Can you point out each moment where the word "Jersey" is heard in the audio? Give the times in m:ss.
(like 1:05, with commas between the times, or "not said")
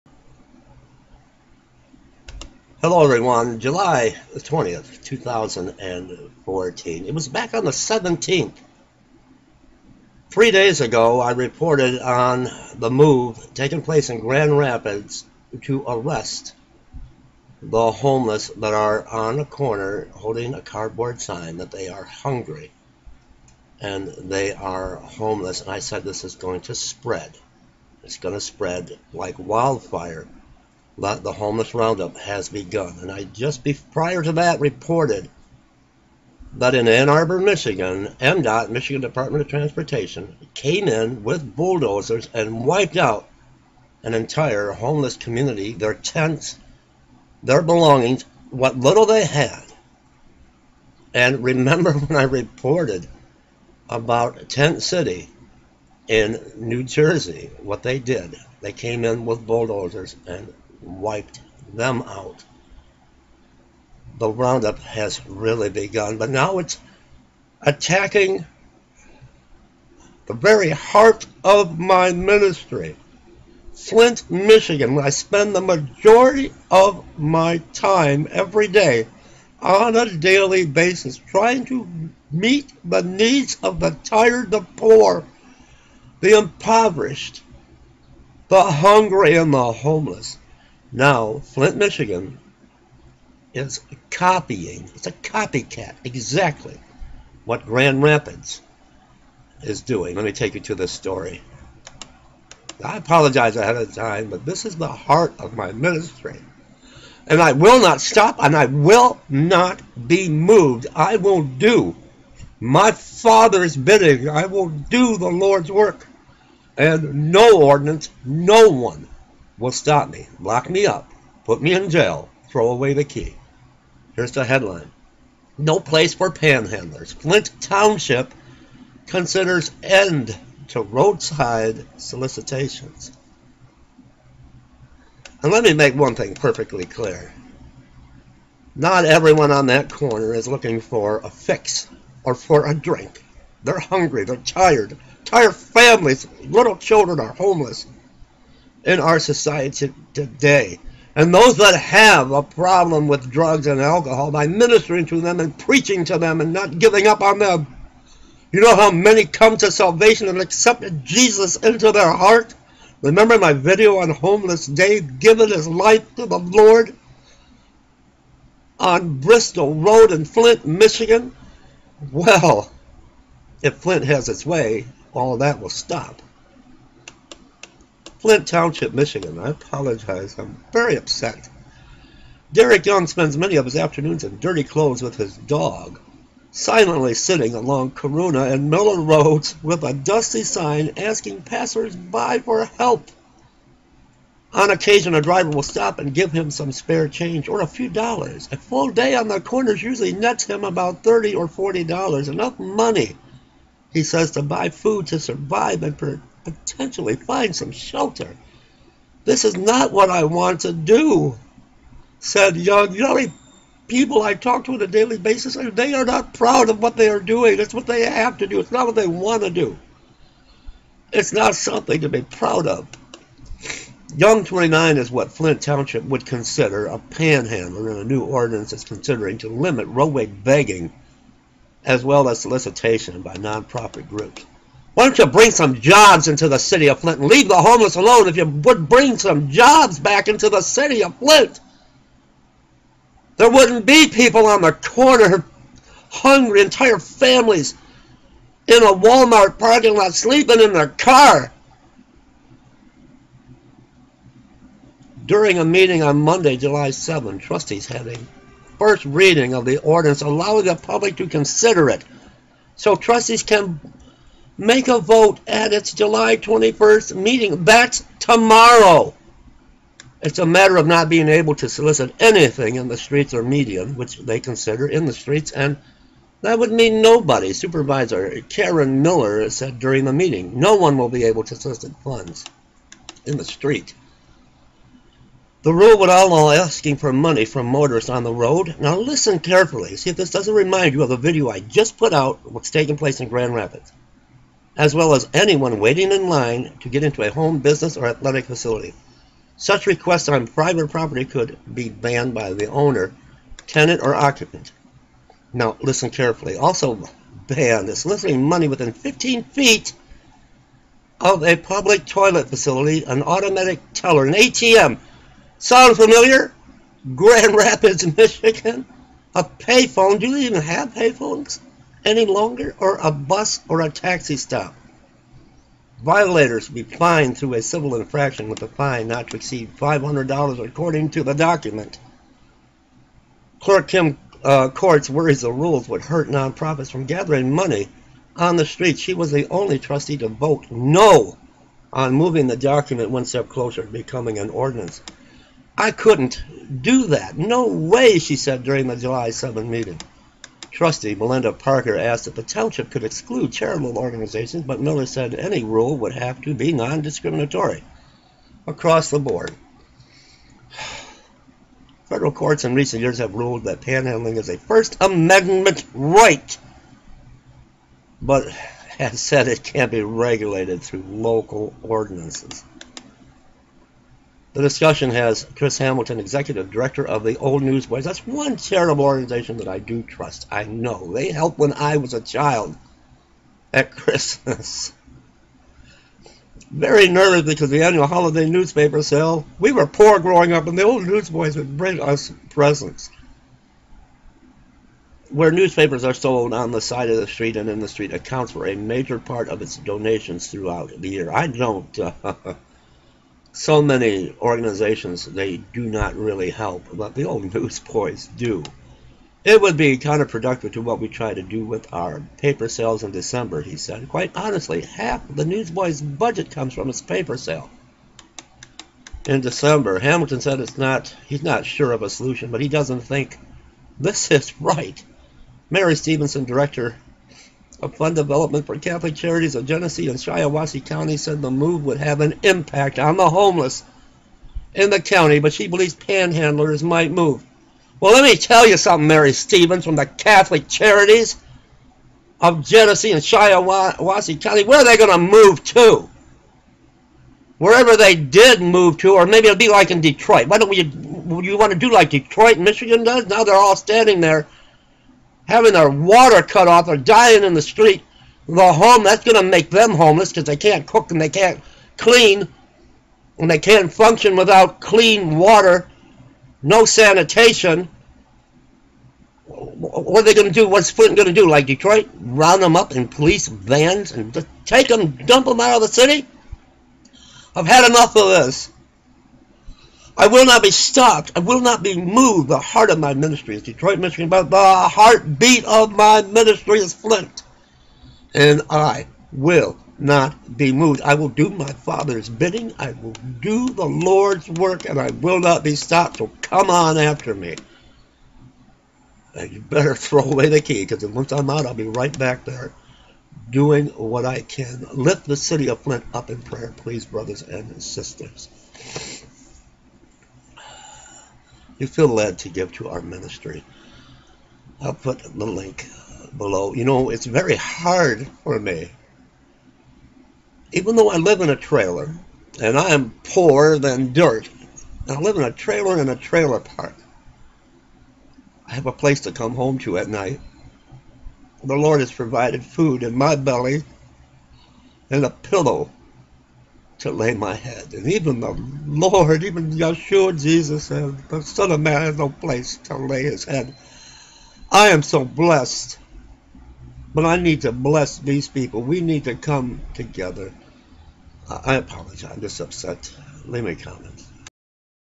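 0:56.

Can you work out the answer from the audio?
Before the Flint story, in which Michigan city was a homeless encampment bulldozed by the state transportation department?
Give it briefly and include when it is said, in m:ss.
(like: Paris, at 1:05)
Ann Arbor, at 0:36.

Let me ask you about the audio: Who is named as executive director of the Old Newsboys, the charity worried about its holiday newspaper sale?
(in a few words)
Chris Hamilton.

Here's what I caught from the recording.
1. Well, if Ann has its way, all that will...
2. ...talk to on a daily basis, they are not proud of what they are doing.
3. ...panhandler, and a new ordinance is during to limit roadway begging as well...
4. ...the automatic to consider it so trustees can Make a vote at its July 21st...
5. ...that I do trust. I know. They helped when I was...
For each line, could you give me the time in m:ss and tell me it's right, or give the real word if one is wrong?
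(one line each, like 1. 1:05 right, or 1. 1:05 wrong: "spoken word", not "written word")
1. 2:52 wrong: "Flint", not "Ann"
2. 3:34 right
3. 3:46 wrong: "considering", not "during"
4. 4:20 wrong: "public", not "automatic"
5. 6:19 right.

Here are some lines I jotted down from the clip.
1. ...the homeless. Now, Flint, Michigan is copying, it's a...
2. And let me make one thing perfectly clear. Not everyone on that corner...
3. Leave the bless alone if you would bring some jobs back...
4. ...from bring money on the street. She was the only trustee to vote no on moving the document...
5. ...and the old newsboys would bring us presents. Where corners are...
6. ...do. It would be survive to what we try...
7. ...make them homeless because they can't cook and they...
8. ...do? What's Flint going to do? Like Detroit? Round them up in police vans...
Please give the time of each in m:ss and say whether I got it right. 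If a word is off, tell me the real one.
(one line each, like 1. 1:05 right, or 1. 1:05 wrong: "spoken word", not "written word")
1. 1:29 right
2. 2:15 right
3. 3:57 wrong: "homeless", not "bless"
4. 5:36 wrong: "gathering", not "bring"
5. 6:30 wrong: "newspapers", not "corners"
6. 6:48 wrong: "counterproductive", not "survive"
7. 7:39 right
8. 7:50 right.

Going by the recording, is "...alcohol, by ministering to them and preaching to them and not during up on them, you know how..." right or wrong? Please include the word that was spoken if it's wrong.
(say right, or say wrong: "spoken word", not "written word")
wrong: "giving", not "during".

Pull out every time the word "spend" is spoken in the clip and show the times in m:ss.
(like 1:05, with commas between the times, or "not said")
1:15, 3:03.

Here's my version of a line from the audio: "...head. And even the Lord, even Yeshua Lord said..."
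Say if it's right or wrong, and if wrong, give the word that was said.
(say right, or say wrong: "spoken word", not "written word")
wrong: "Jesus", not "Lord".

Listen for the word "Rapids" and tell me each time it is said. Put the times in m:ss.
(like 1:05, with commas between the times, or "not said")
0:14, 1:38, 4:53, 5:17.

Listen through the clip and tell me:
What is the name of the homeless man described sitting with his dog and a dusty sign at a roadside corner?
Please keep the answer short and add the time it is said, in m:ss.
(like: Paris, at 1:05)
Derek Young, at 3:02.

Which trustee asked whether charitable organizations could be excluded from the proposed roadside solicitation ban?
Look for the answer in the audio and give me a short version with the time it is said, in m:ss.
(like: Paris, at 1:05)
Melinda Parker, at 5:51.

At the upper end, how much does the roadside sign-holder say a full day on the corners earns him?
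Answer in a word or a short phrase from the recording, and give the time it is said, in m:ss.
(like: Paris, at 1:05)
$40, at 3:21.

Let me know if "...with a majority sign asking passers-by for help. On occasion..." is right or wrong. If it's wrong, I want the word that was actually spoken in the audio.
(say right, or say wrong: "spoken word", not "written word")
wrong: "dusty", not "majority".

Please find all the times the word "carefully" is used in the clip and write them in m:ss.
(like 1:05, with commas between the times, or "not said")
4:49, 5:06.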